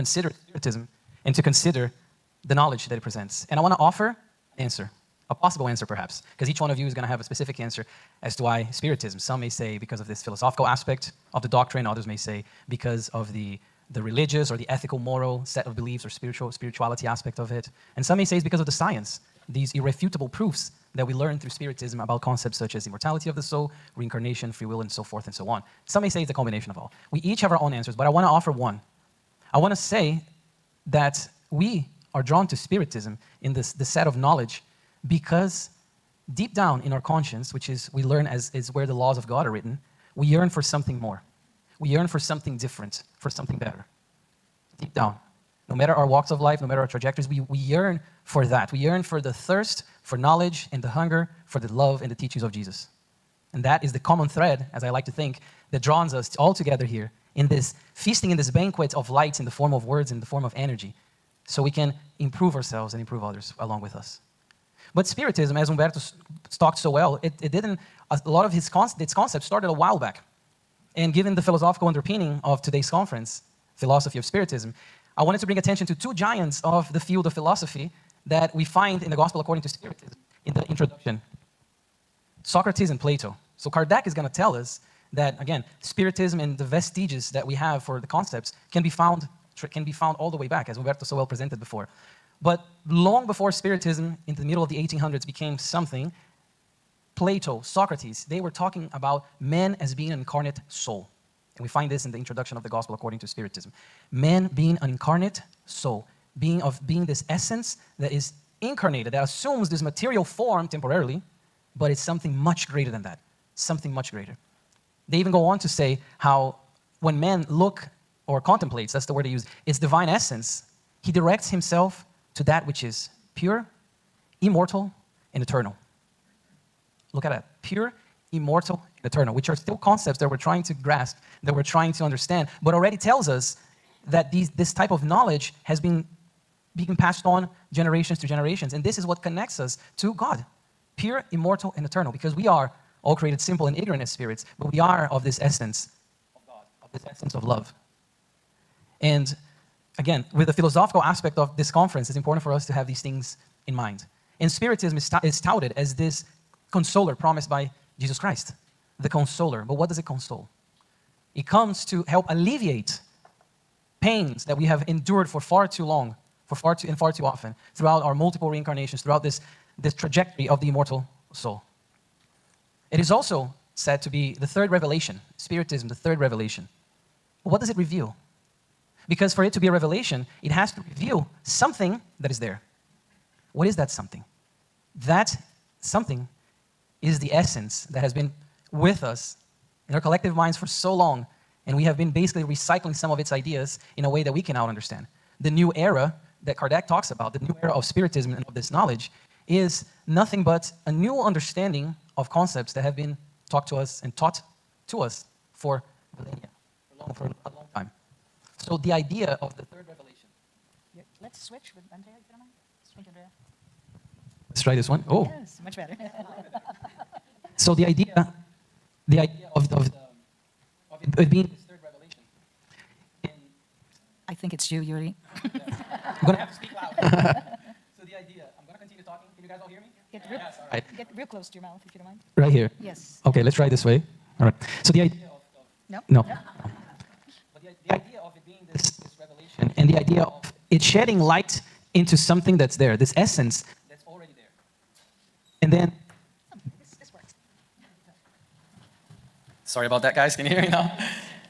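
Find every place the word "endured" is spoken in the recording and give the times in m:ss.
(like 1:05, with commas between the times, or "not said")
2:44.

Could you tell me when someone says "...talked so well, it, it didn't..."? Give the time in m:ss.
1:06.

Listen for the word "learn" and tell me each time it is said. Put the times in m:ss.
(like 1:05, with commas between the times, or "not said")
0:21, 0:38.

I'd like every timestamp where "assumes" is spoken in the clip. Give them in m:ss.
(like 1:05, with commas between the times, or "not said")
1:49.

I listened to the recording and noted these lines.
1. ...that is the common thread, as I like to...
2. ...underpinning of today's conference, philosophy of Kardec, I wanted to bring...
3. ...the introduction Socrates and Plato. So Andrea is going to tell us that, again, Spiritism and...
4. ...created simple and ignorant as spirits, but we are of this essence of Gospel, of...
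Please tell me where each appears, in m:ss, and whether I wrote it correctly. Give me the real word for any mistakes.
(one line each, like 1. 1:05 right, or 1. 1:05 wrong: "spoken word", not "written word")
1. 0:53 right
2. 1:11 wrong: "Spiritism", not "Kardec"
3. 1:20 wrong: "Kardec", not "Andrea"
4. 2:23 wrong: "God", not "Gospel".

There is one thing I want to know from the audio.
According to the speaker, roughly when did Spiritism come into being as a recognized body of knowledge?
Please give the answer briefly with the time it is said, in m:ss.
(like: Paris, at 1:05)
middle of the 1800s, at 1:34.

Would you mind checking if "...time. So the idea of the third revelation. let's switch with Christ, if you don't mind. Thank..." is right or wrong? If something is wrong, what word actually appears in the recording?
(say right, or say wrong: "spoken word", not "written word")
wrong: "Andrea", not "Christ".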